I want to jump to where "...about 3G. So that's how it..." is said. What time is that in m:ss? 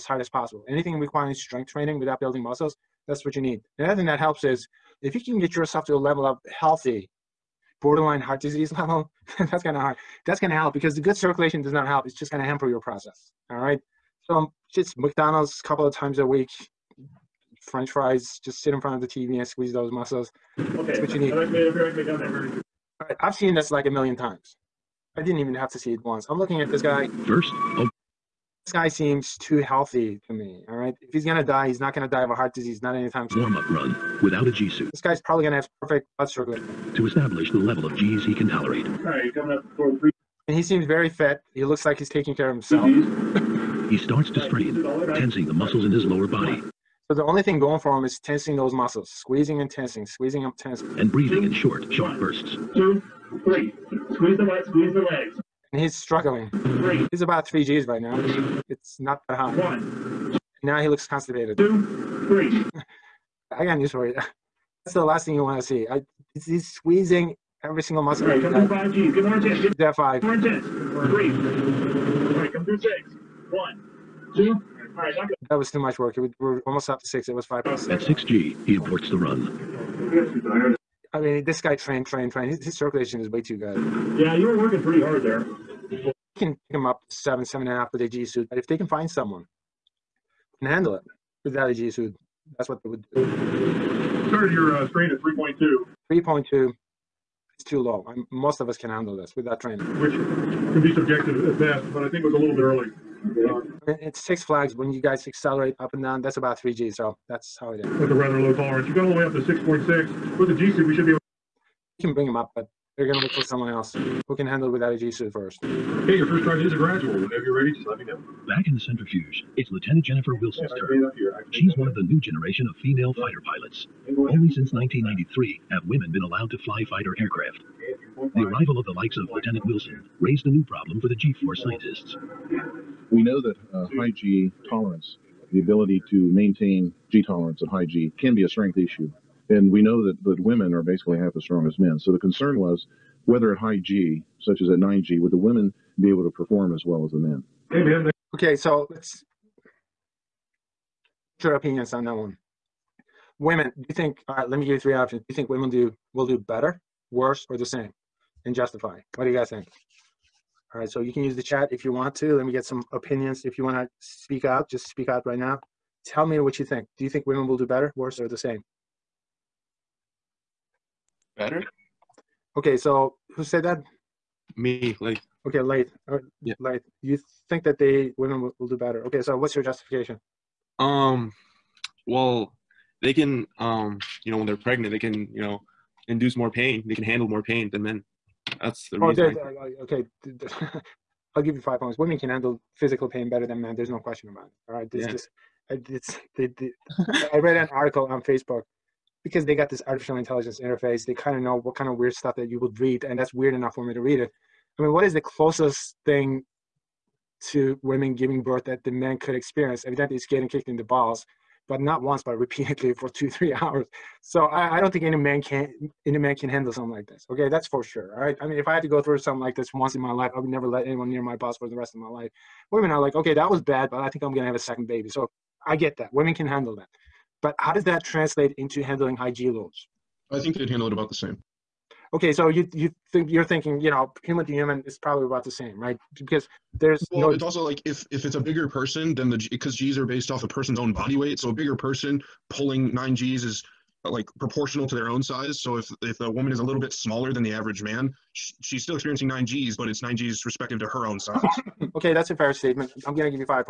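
1:46.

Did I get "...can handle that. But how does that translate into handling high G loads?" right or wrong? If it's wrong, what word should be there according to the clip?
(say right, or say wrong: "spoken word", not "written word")
right.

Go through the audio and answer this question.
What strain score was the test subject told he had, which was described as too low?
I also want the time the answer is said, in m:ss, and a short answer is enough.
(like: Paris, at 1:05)
3.2, at 1:34.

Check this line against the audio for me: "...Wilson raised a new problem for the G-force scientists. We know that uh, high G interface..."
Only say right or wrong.
wrong.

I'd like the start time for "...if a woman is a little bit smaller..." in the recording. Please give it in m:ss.
4:06.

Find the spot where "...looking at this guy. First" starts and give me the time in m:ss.
0:26.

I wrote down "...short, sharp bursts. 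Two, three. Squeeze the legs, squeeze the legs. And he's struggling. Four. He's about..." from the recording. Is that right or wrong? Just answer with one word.
wrong.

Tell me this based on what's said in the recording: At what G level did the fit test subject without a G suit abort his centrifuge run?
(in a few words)
6 G.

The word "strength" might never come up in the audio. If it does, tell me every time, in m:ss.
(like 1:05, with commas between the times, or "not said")
0:01, 2:18.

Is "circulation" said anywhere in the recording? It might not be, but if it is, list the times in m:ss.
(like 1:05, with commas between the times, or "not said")
0:11, 1:22.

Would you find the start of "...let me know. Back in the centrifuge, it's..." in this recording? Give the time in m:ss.
1:57.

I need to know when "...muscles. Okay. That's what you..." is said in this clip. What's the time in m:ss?
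0:19.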